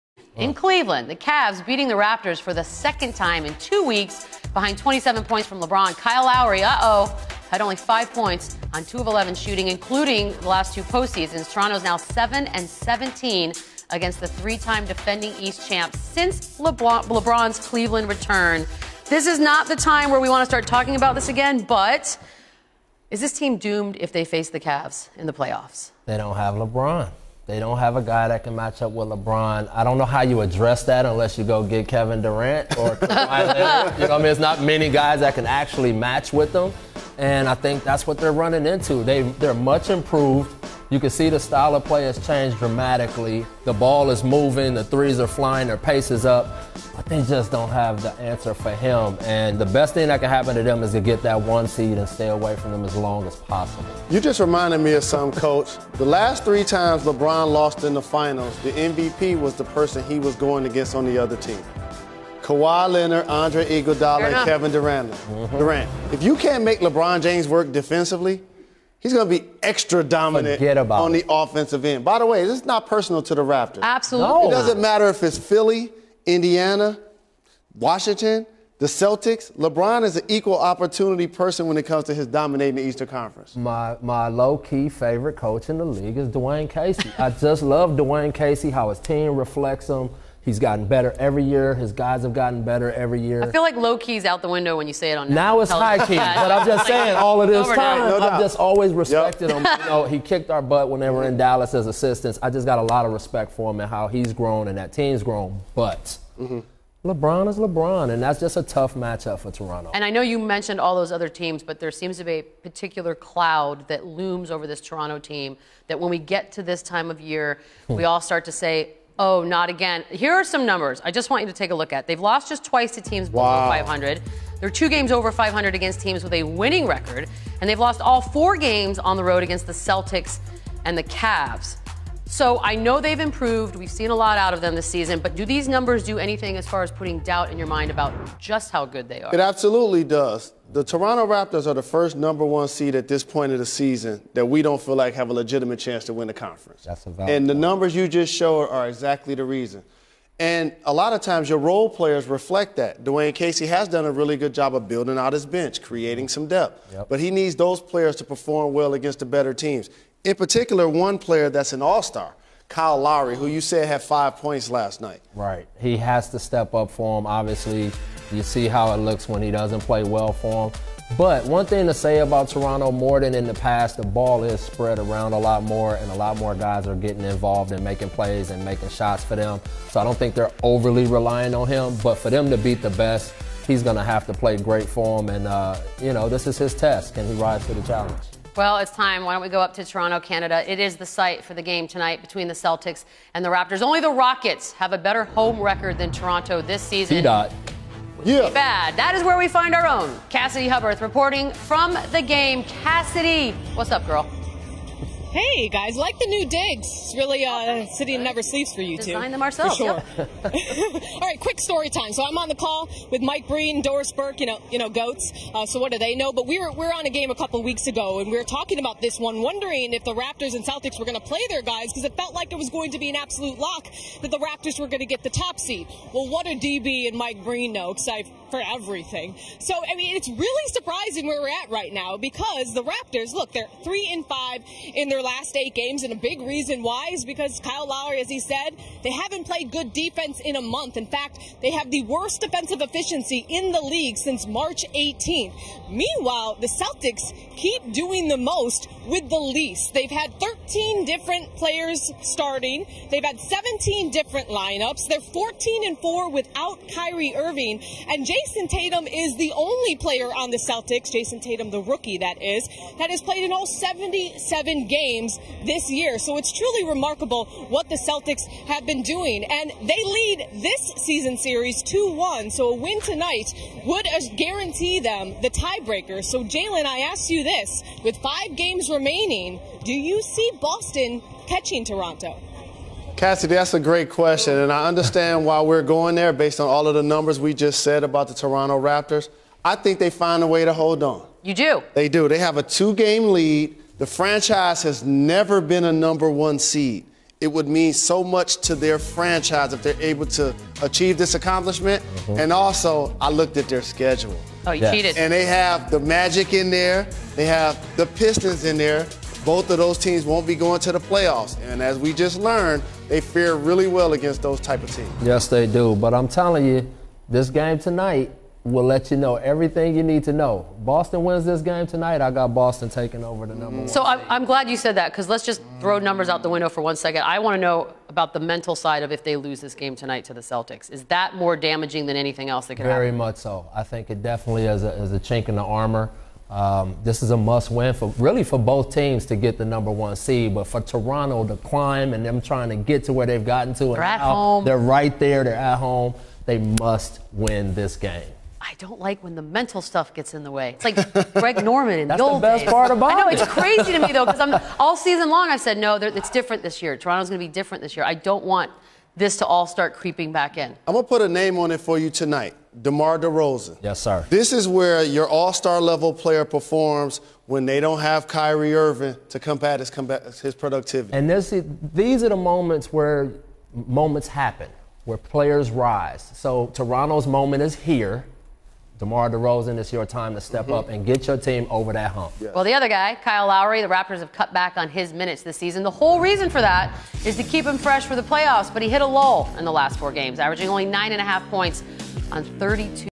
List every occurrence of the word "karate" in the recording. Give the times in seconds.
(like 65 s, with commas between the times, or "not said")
not said.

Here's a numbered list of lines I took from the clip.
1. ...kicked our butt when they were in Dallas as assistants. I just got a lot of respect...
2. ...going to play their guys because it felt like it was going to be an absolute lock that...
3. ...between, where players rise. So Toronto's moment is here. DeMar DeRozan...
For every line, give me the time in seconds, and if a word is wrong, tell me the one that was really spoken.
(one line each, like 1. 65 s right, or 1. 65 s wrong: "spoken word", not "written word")
1. 100 s right
2. 221 s right
3. 374 s wrong: "happen", not "between".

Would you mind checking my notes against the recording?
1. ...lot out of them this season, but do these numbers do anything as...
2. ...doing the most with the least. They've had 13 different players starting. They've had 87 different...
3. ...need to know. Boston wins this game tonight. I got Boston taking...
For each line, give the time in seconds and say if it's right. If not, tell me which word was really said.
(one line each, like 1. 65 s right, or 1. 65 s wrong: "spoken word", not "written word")
1. 134 s right
2. 247 s wrong: "17", not "87"
3. 320 s right.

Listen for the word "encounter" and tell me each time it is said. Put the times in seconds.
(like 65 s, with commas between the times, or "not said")
not said.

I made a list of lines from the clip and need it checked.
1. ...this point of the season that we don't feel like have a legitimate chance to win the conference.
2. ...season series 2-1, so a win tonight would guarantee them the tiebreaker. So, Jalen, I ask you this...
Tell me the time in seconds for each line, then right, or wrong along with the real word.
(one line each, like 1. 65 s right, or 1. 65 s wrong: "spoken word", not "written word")
1. 143 s right
2. 271 s right.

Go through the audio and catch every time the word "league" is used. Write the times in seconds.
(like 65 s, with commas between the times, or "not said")
85 s, 243 s.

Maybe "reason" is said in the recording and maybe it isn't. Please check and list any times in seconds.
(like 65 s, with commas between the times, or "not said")
149 s, 236 s, 386 s.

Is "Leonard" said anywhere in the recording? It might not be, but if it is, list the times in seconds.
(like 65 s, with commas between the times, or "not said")
33 s, 62 s.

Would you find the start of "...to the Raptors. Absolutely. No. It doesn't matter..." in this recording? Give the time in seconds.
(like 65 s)
73 s.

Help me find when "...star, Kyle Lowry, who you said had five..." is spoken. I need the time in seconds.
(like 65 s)
162 s.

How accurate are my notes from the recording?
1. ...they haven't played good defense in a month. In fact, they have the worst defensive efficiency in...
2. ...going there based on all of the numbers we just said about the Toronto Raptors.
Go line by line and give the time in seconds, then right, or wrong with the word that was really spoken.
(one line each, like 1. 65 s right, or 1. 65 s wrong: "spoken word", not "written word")
1. 239 s right
2. 285 s right.